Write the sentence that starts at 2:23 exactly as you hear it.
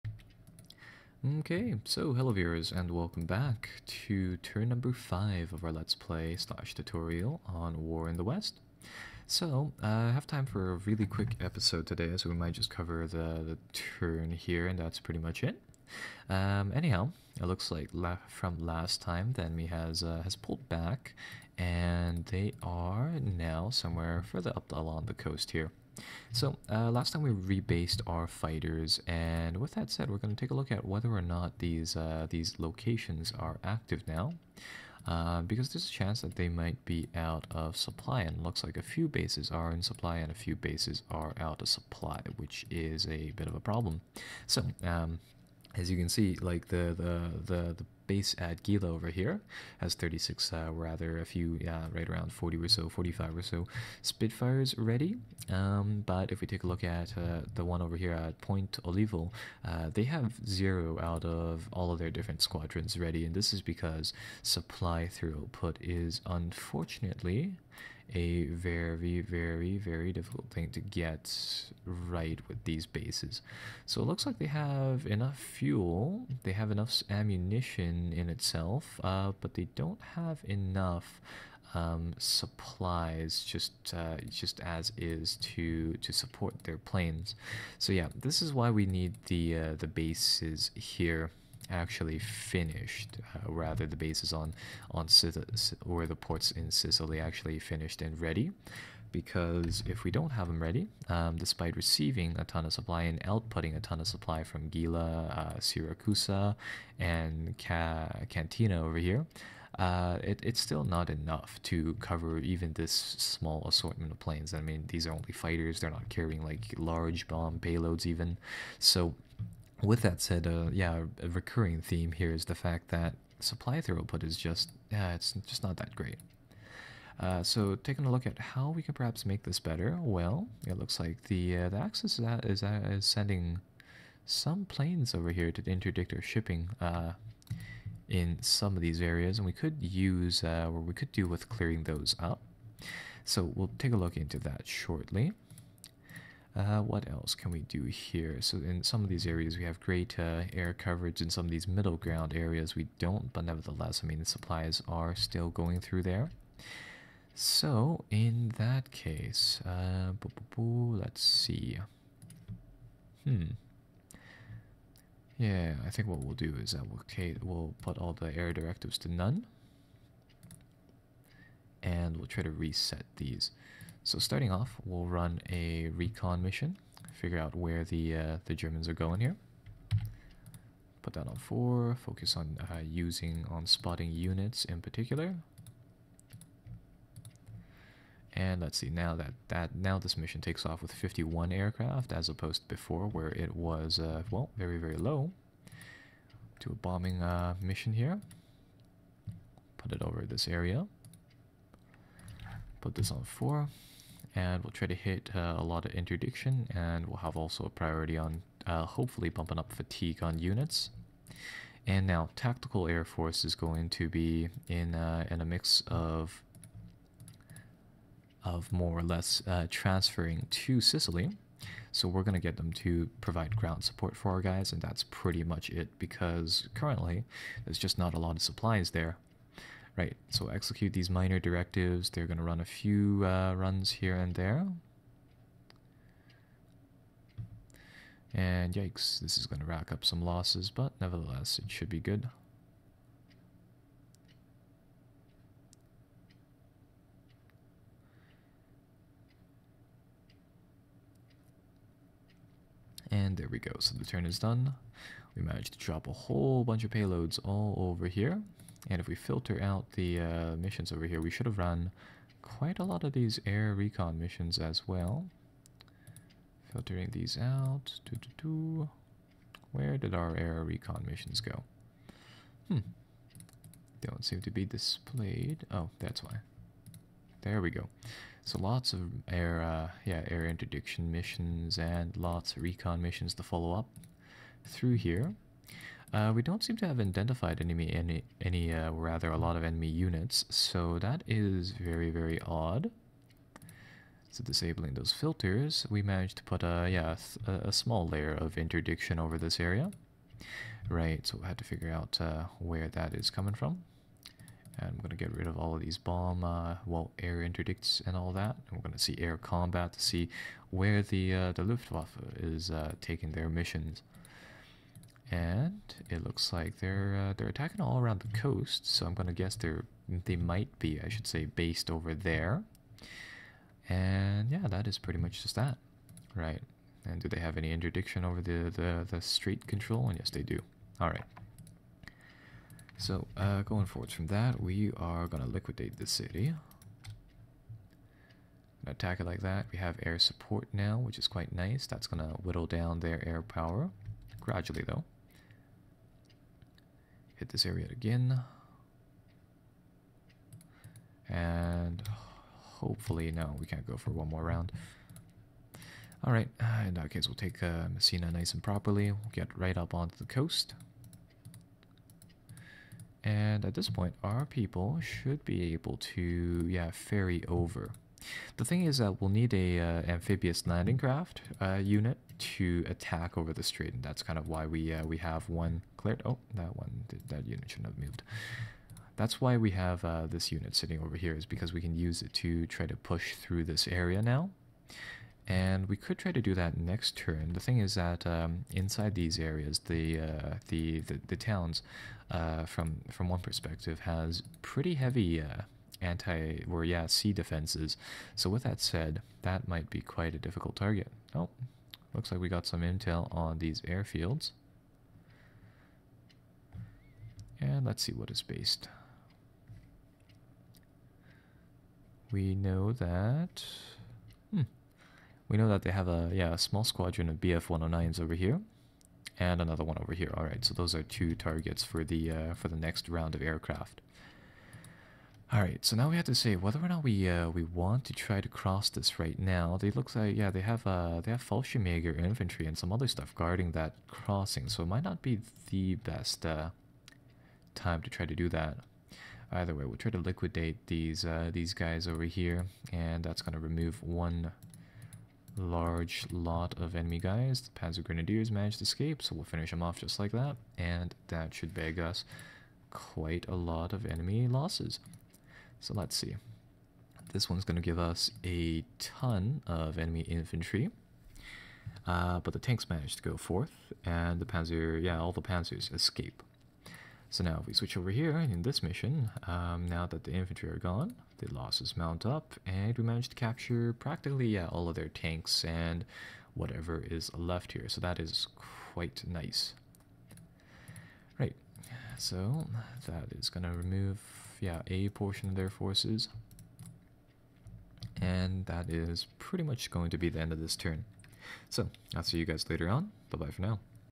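So we'll take a look into that shortly.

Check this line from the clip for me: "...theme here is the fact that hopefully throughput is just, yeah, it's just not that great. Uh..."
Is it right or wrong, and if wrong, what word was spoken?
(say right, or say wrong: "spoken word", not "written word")
wrong: "supply", not "hopefully".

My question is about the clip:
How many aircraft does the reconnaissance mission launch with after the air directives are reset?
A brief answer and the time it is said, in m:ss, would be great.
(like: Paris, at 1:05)
51, at 3:10.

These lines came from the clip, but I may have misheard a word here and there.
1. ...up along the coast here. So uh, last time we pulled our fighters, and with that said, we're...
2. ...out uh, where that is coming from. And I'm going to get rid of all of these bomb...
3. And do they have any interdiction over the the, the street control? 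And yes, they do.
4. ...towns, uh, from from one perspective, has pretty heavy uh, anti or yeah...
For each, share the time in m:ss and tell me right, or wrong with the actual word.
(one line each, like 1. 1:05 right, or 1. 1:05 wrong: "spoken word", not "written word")
1. 0:24 wrong: "rebased", not "pulled"
2. 5:01 right
3. 5:27 right
4. 6:31 right.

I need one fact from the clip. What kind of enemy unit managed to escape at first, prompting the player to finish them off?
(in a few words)
Panzer Grenadiers.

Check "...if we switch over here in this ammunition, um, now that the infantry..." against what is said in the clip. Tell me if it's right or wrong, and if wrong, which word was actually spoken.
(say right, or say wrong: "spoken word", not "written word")
wrong: "mission", not "ammunition".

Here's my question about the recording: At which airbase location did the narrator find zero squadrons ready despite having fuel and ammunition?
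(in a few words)
Ponte Olivo.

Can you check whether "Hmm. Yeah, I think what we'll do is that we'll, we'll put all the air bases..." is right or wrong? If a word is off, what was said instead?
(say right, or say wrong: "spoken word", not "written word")
wrong: "directives", not "bases".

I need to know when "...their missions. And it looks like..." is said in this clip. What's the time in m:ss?
5:13.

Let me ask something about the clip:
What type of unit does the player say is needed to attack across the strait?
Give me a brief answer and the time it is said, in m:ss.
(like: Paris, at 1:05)
amphibious landing craft, at 6:10.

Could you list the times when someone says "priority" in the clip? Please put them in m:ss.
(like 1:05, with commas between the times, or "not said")
3:27.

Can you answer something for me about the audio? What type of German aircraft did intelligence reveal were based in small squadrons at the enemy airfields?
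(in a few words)
BF-109s.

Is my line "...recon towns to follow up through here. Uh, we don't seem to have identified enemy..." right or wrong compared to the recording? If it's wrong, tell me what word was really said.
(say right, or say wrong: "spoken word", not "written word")
wrong: "missions", not "towns".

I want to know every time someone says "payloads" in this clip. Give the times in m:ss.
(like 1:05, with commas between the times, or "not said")
1:57, 4:16.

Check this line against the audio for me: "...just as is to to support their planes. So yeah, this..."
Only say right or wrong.
right.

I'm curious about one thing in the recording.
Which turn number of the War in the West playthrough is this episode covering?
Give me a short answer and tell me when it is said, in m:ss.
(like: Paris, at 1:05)
5, at 0:04.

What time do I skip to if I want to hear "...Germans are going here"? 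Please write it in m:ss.
2:58.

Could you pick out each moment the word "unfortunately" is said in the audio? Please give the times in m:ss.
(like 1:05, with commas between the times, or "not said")
1:06.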